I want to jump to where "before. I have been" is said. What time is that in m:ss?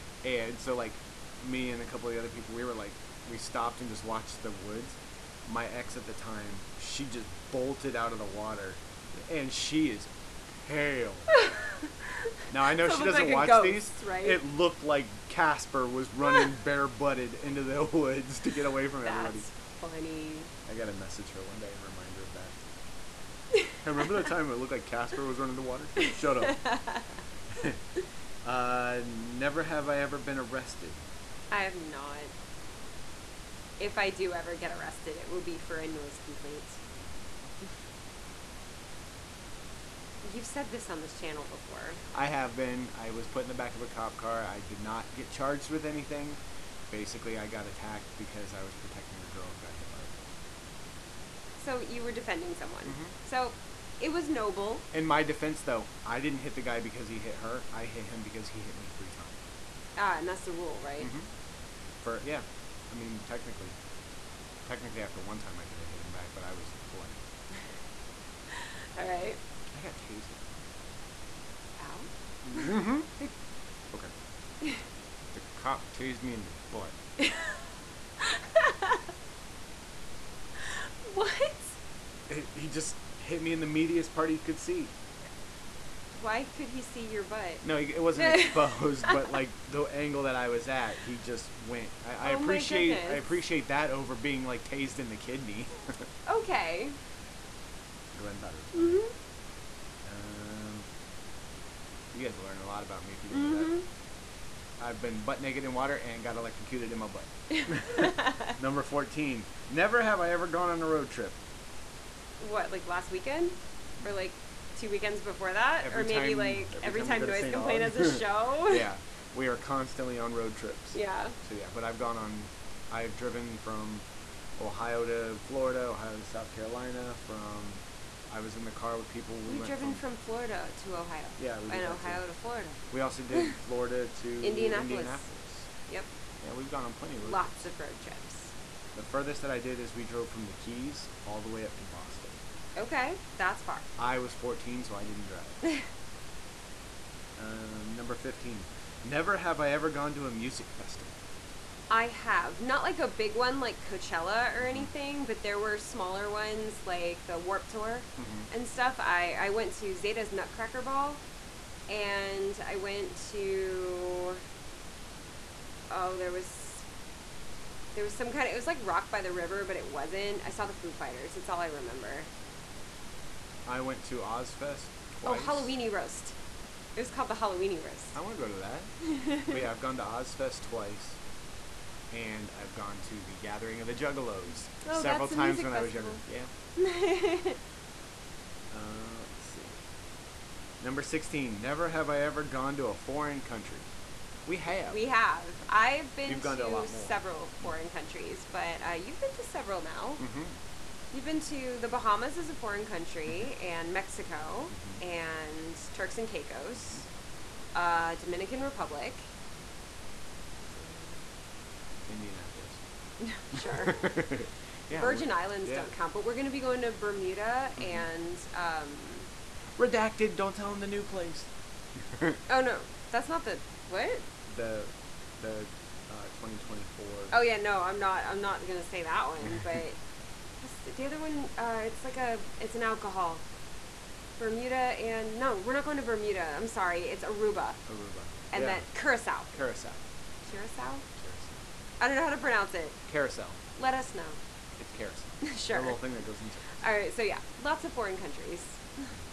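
0:41.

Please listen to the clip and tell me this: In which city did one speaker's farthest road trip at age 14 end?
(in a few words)
Boston.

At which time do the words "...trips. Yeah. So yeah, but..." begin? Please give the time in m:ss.
2:00.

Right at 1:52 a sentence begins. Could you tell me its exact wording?
What, like last weekend, or mm.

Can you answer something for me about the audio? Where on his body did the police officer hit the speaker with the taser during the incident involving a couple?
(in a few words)
In the butt.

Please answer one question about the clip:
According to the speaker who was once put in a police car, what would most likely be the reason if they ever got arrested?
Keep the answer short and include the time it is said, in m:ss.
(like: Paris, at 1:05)
A noise complaint, at 0:35.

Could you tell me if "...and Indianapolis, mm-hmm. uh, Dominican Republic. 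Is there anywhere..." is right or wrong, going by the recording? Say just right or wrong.
wrong.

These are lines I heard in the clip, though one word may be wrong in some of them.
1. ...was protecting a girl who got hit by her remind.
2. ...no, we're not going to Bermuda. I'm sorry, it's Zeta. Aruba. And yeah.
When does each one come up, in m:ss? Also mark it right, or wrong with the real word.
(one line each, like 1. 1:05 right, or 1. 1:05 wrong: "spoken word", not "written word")
1. 0:48 wrong: "boyfriend", not "remind"
2. 3:55 wrong: "Aruba", not "Zeta".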